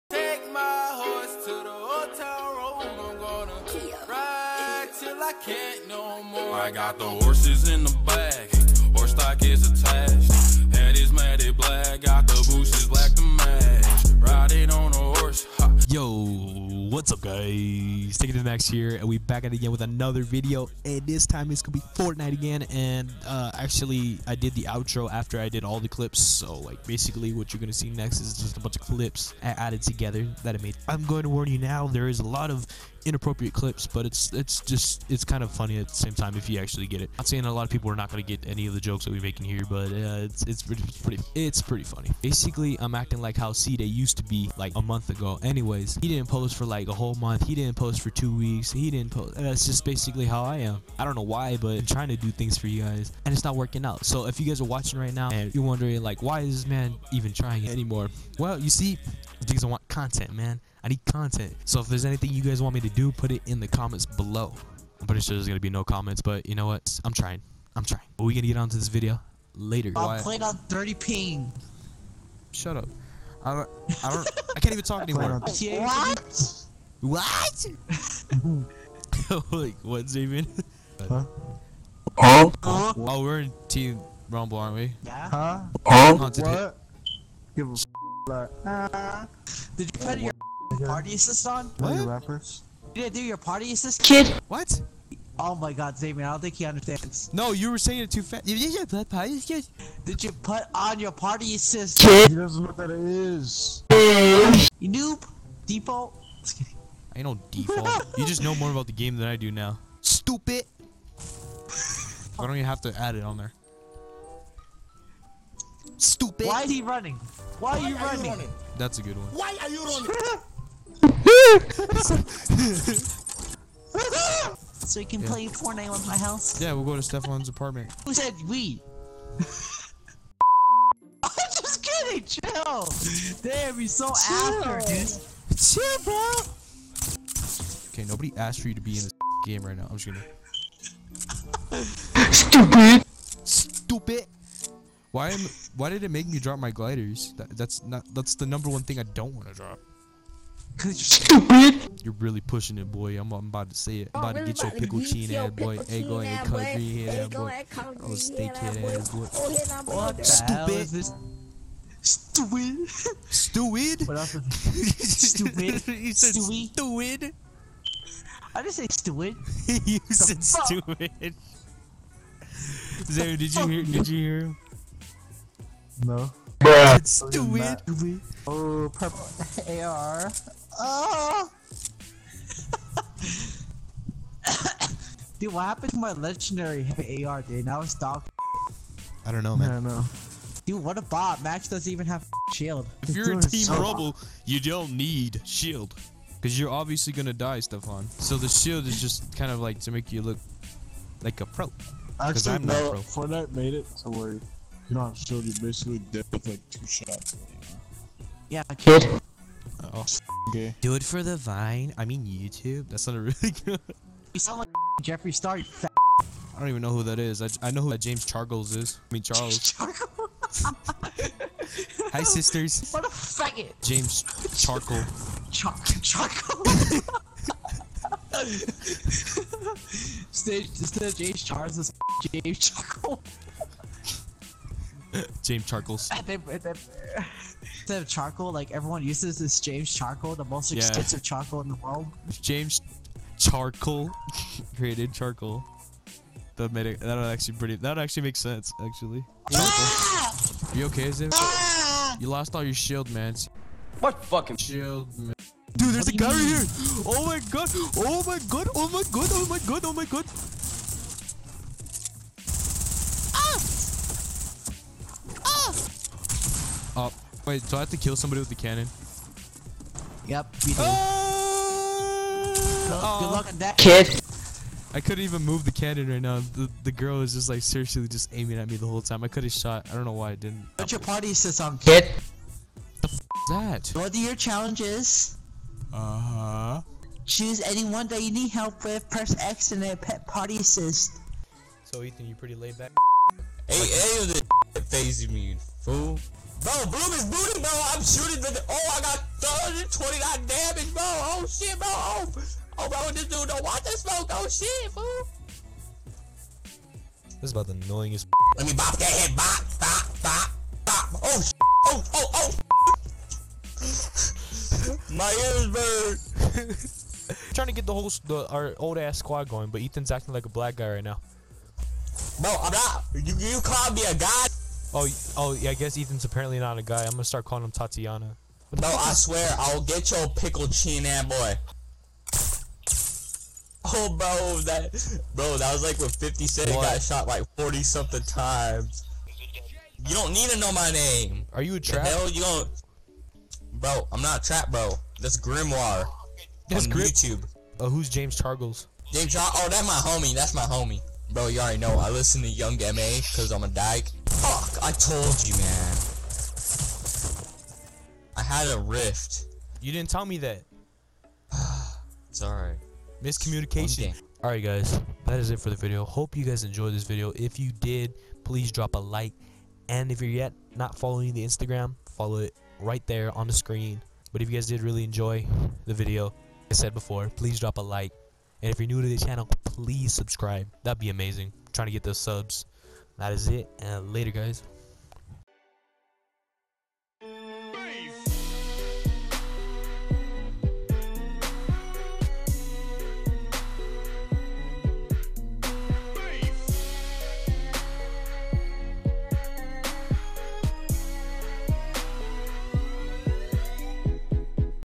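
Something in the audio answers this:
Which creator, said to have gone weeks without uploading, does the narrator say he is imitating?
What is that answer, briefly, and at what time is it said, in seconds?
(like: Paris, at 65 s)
C Day, at 43 s.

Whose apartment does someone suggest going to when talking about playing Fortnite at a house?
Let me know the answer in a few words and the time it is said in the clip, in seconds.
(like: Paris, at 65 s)
Stefan's apartment, at 127 s.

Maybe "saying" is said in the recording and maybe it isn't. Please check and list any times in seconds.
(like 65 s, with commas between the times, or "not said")
37 s, 97 s.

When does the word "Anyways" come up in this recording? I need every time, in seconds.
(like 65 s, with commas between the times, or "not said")
45 s.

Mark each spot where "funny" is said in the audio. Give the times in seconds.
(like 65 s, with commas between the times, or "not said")
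35 s, 41 s.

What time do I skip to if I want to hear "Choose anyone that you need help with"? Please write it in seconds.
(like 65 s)
287 s.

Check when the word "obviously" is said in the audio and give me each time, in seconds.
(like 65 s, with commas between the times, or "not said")
196 s.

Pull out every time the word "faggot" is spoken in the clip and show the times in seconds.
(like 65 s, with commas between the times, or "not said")
223 s.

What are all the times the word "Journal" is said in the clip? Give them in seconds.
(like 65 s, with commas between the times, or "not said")
not said.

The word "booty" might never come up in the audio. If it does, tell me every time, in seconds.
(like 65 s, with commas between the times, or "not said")
297 s.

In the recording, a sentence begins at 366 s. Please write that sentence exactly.
Hope you guys enjoyed this video.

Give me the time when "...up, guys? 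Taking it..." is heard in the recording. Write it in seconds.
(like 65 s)
17 s.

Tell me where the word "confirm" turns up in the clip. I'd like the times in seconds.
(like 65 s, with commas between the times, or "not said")
not said.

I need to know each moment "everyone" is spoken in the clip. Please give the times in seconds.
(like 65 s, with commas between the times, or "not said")
238 s.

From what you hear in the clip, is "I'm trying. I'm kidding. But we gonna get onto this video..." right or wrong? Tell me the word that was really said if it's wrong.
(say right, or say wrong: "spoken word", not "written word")
wrong: "trying", not "kidding".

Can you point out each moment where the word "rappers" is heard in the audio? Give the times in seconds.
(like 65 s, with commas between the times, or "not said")
92 s.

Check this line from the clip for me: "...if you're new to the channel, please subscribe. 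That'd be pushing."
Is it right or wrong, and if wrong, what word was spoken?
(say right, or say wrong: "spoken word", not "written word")
wrong: "amazing", not "pushing".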